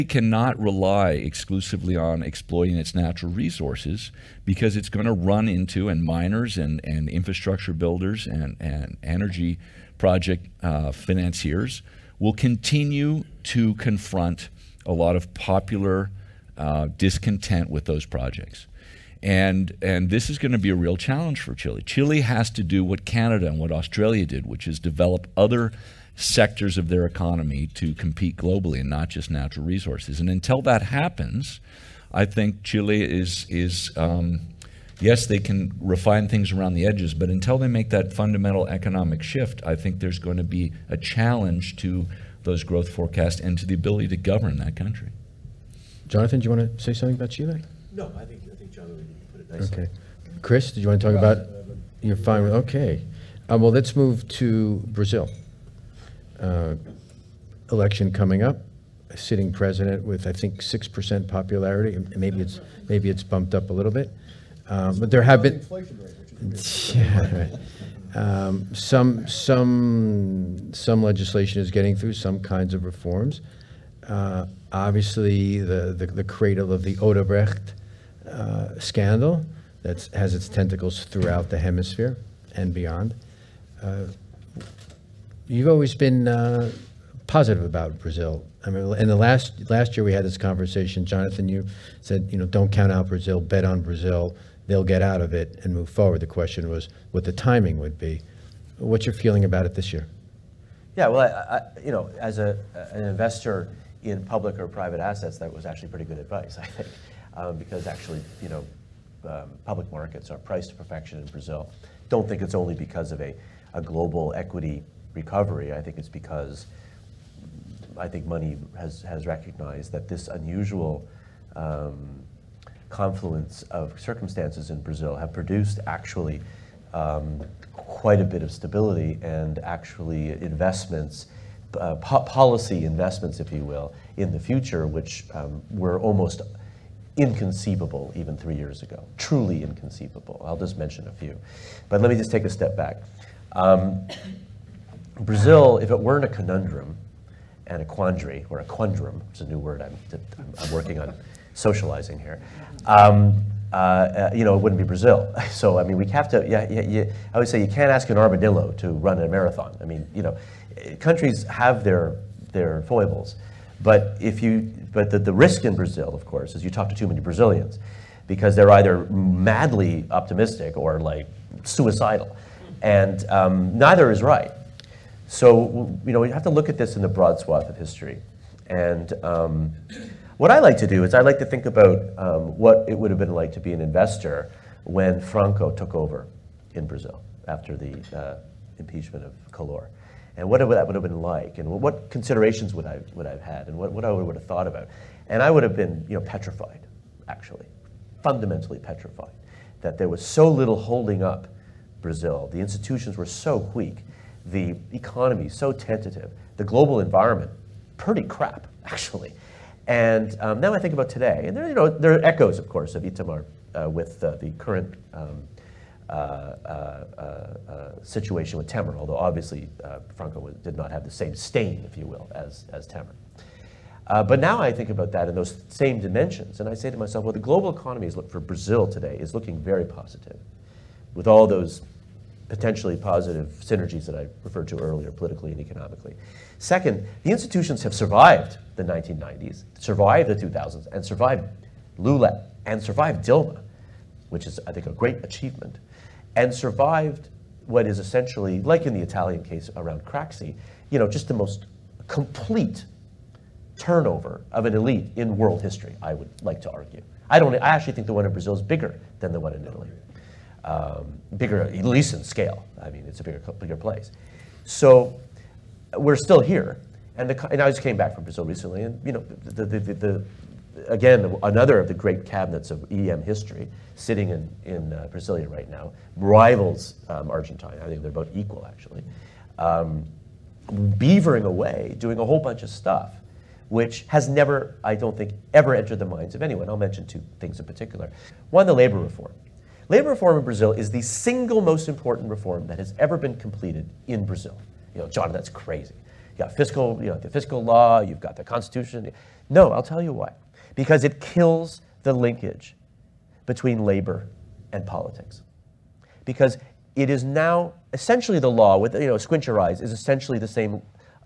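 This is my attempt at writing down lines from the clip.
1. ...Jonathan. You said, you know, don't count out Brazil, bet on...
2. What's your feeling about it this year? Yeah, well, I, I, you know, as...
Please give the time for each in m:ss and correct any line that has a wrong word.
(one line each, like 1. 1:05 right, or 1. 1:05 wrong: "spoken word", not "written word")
1. 1:31 right
2. 1:38 right.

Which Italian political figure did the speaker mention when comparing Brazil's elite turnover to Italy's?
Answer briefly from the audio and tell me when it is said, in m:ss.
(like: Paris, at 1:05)
Craxi, at 4:10.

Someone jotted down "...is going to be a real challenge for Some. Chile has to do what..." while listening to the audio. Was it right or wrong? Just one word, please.
wrong.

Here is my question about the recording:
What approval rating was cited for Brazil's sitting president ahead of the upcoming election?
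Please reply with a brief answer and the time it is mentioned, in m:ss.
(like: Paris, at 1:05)
6%, at 1:00.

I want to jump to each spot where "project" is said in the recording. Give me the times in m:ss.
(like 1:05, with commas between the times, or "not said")
0:09, 0:18.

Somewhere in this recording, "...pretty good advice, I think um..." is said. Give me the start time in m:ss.
1:45.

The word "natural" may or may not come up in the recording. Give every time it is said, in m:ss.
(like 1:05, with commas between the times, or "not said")
0:02, 0:29.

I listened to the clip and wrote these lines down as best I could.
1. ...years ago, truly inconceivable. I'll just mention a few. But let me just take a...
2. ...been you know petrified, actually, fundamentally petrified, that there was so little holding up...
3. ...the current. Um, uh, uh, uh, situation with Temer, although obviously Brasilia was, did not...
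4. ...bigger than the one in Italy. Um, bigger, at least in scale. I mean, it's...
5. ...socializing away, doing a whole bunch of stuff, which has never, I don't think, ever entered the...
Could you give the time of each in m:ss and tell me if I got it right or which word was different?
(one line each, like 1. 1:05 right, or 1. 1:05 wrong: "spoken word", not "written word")
1. 2:18 right
2. 3:15 right
3. 3:34 wrong: "Franco", not "Brasilia"
4. 4:18 right
5. 4:40 wrong: "beavering", not "socializing".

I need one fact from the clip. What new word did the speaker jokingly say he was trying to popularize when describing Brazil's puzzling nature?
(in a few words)
quandrum.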